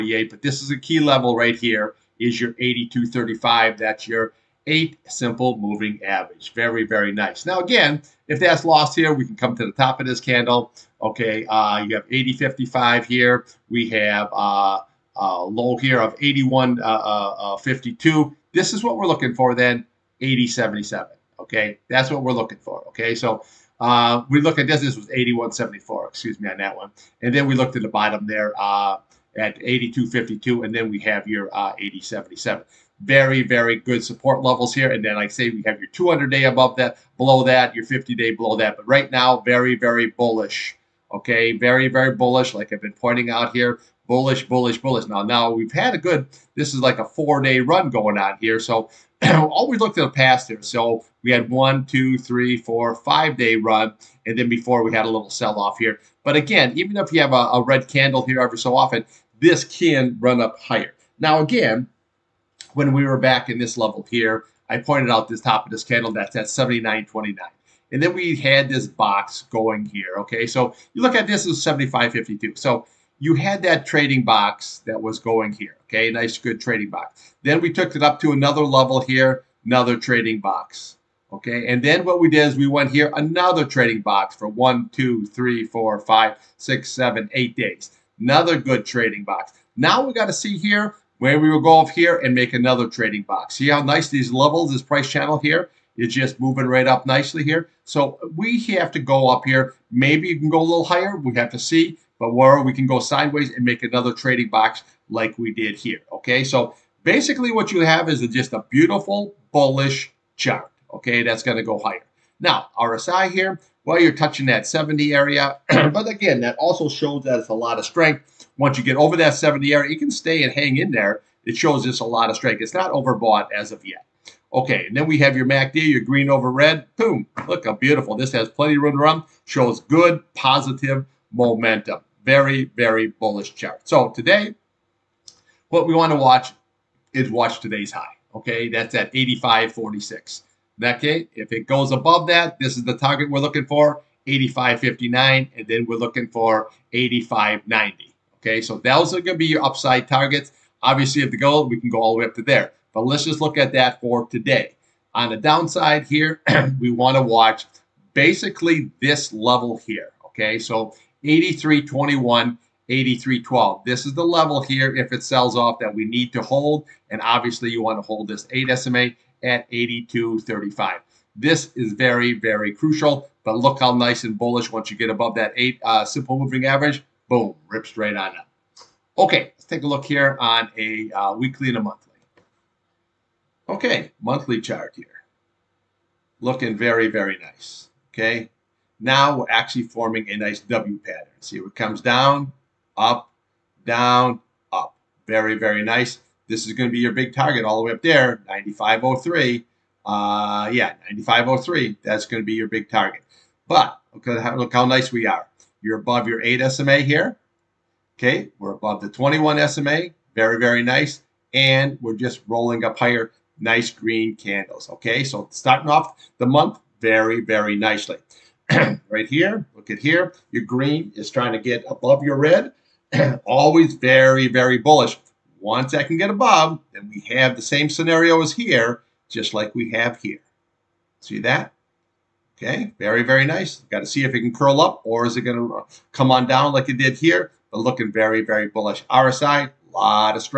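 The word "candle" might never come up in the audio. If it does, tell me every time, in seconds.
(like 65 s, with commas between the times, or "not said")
10 s, 57 s, 65 s, 214 s.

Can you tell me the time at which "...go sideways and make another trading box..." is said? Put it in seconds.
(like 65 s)
102 s.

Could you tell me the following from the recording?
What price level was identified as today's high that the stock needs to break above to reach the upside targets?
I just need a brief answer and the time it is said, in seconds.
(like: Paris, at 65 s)
85.46, at 139 s.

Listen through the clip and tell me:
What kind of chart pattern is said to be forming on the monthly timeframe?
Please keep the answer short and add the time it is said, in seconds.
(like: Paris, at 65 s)
W pattern, at 190 s.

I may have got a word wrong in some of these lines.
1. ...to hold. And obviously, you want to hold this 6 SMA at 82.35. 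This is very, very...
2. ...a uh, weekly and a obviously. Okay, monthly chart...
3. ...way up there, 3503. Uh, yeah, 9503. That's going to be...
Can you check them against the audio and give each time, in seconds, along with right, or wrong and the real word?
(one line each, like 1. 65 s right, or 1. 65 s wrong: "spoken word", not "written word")
1. 166 s wrong: "8", not "6"
2. 180 s wrong: "monthly", not "obviously"
3. 197 s wrong: "9503", not "3503".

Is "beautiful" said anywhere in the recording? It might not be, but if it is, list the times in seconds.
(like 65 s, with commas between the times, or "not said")
108 s, 127 s.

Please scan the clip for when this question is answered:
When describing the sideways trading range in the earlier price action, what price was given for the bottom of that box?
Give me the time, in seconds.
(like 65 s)
71 s.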